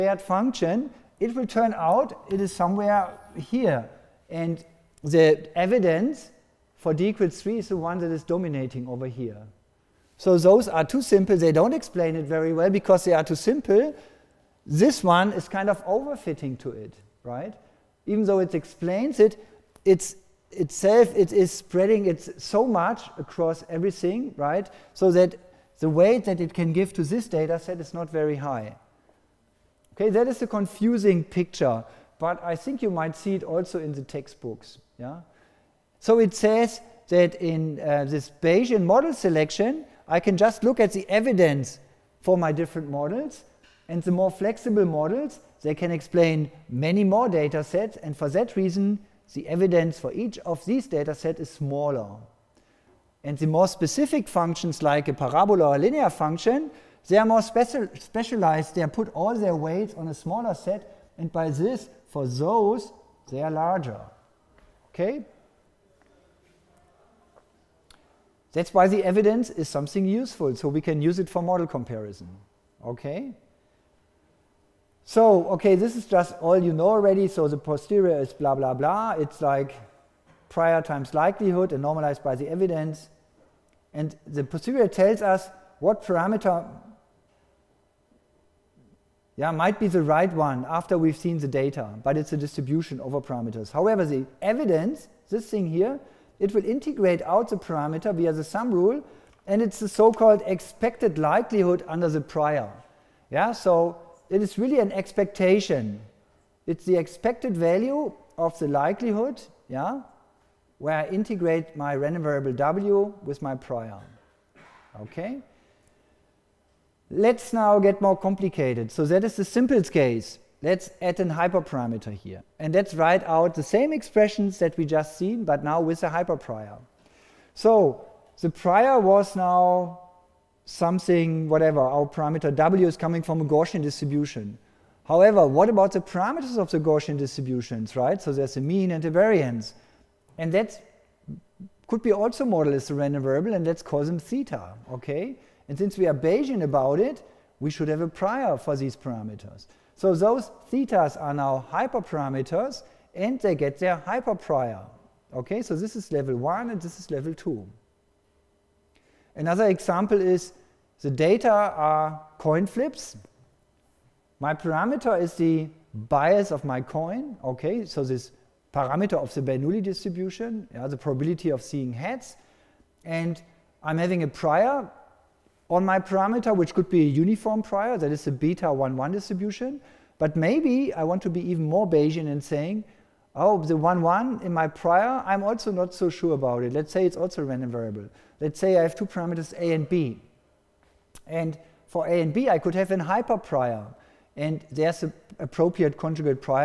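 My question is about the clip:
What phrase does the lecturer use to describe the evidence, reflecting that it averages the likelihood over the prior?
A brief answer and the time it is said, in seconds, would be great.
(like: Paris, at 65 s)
expected likelihood under the prior, at 100 s.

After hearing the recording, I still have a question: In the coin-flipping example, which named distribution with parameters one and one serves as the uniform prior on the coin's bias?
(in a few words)
beta 1-1.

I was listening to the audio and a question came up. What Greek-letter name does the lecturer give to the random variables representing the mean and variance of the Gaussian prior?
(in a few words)
theta.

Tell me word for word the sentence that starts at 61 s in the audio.
And by this, for those, they are larger.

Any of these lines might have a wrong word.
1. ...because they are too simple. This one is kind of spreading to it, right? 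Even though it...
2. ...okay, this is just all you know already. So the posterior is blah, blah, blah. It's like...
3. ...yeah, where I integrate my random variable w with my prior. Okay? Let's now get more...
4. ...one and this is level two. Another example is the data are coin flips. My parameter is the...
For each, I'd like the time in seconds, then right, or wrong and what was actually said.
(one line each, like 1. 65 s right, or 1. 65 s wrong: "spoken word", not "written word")
1. 12 s wrong: "overfitting", not "spreading"
2. 75 s right
3. 109 s right
4. 156 s right.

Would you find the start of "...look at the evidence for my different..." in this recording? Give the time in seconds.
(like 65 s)
40 s.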